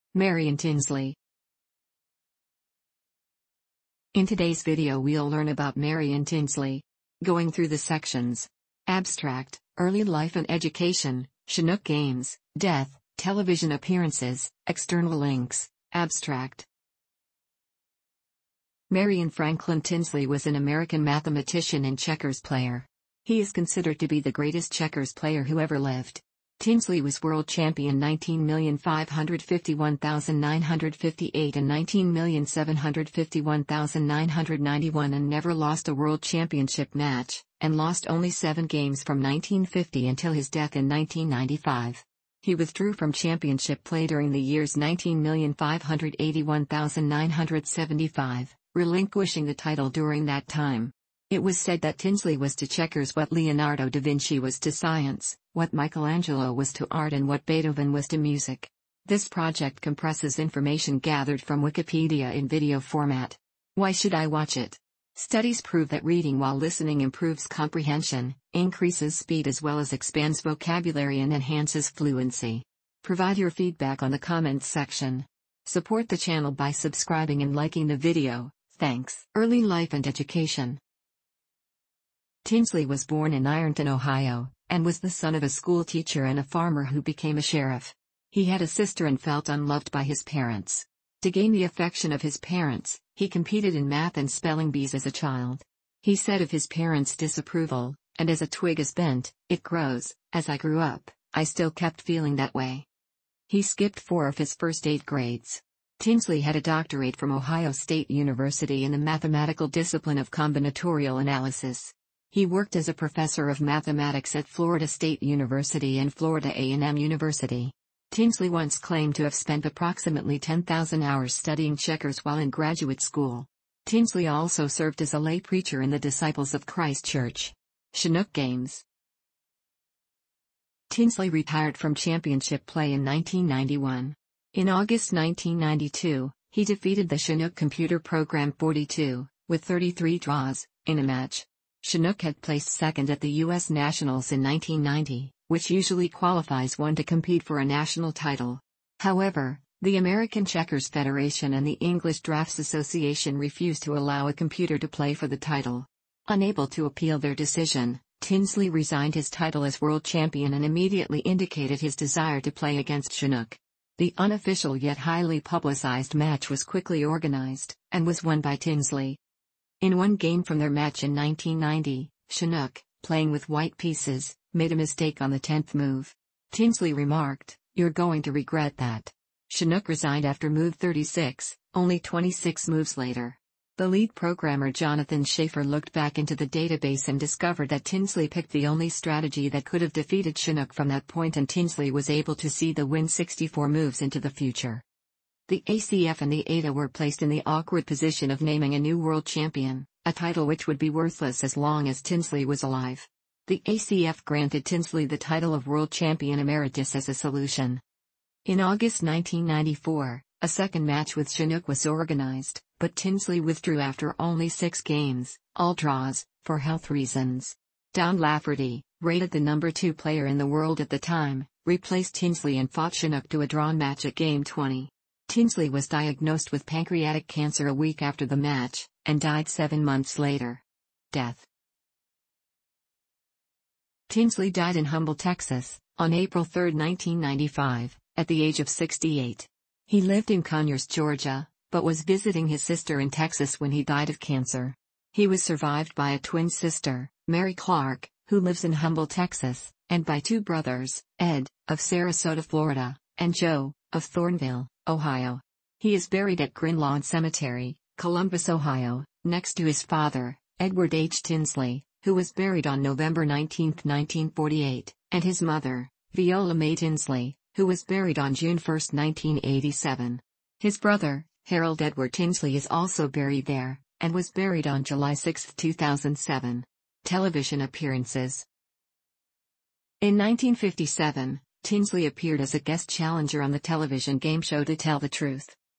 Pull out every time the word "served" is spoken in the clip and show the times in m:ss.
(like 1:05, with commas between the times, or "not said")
2:04.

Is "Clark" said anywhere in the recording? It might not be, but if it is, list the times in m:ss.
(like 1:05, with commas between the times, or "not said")
4:07.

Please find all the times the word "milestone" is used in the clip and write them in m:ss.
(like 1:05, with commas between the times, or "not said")
not said.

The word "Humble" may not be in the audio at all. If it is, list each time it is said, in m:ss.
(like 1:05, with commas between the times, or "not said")
3:54, 4:08.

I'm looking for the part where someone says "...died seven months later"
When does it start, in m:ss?
3:49.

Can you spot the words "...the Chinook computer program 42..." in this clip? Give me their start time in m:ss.
2:17.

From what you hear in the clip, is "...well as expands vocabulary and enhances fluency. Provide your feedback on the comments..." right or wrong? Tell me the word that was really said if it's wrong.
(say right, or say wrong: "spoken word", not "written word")
right.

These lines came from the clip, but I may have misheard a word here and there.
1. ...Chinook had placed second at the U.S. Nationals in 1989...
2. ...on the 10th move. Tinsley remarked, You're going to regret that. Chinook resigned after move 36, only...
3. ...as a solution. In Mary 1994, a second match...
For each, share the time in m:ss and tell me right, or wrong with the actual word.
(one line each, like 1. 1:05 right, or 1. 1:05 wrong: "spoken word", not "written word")
1. 2:21 wrong: "1990", not "1989"
2. 2:55 right
3. 3:26 wrong: "August", not "Mary".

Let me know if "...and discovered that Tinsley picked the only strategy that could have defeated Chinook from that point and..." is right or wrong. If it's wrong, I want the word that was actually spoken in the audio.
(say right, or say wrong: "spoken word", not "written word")
right.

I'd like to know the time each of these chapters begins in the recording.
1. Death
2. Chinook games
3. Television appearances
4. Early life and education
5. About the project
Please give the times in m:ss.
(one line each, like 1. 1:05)
1. 3:51
2. 2:08
3. 4:37
4. 1:19
5. 0:59.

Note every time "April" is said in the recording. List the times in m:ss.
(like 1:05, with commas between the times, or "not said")
3:56.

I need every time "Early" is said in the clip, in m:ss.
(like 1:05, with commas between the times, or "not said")
0:09, 1:19.